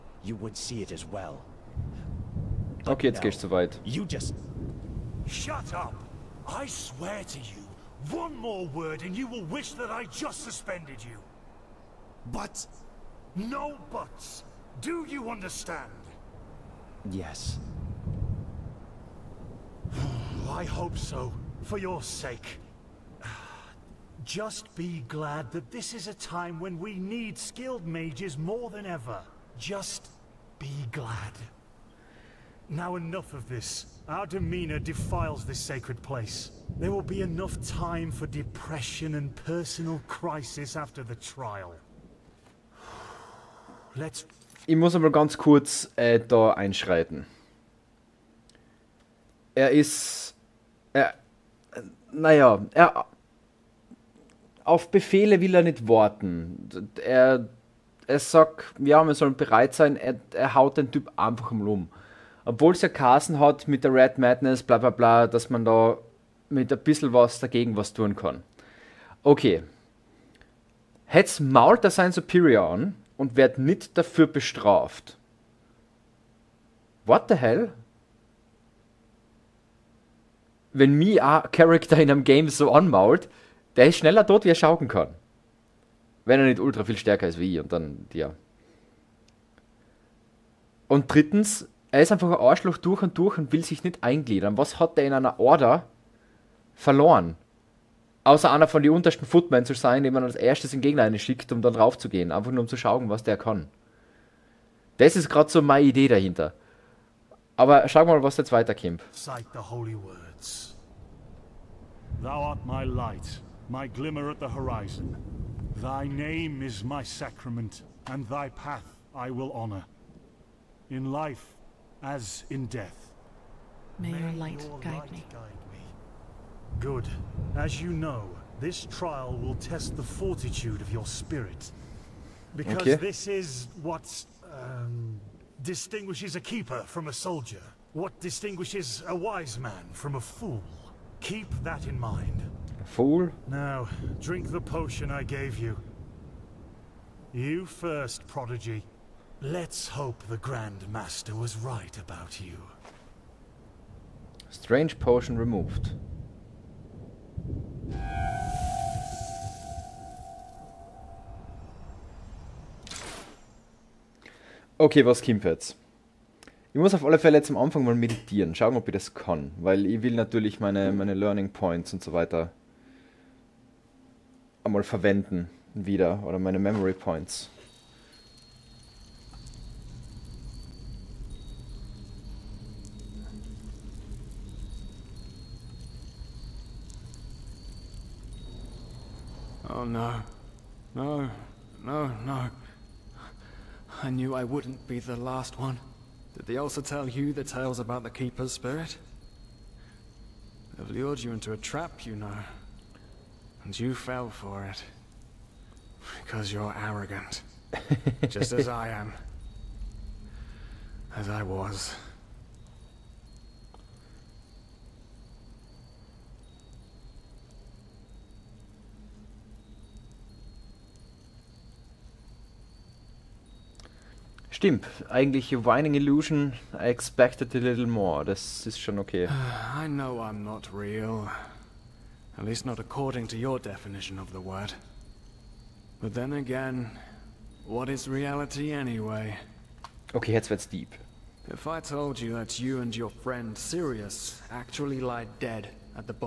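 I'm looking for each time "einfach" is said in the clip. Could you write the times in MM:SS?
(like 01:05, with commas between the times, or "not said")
01:01, 01:32, 01:42.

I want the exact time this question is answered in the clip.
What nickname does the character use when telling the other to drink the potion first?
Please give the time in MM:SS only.
02:28.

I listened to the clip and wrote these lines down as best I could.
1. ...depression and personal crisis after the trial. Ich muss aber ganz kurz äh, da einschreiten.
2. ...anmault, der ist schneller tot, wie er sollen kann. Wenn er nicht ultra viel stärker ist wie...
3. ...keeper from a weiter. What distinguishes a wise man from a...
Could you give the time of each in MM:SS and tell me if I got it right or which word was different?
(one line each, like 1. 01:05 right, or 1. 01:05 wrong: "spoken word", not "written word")
1. 00:38 right
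2. 01:22 wrong: "schauken", not "sollen"
3. 02:16 wrong: "soldier", not "weiter".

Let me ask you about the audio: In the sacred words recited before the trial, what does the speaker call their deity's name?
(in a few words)
my sacrament.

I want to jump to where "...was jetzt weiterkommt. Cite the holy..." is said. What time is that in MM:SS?
01:48.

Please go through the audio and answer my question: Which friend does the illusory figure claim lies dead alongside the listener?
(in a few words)
Sirius.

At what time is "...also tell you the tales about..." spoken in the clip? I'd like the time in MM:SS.
03:16.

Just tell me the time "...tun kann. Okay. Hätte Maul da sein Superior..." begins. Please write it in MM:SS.
01:07.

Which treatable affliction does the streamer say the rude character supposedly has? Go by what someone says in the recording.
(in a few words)
Red Madness.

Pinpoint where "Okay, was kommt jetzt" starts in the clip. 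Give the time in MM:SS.
02:44.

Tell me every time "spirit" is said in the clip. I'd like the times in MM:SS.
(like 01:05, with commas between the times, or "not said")
02:11, 03:18.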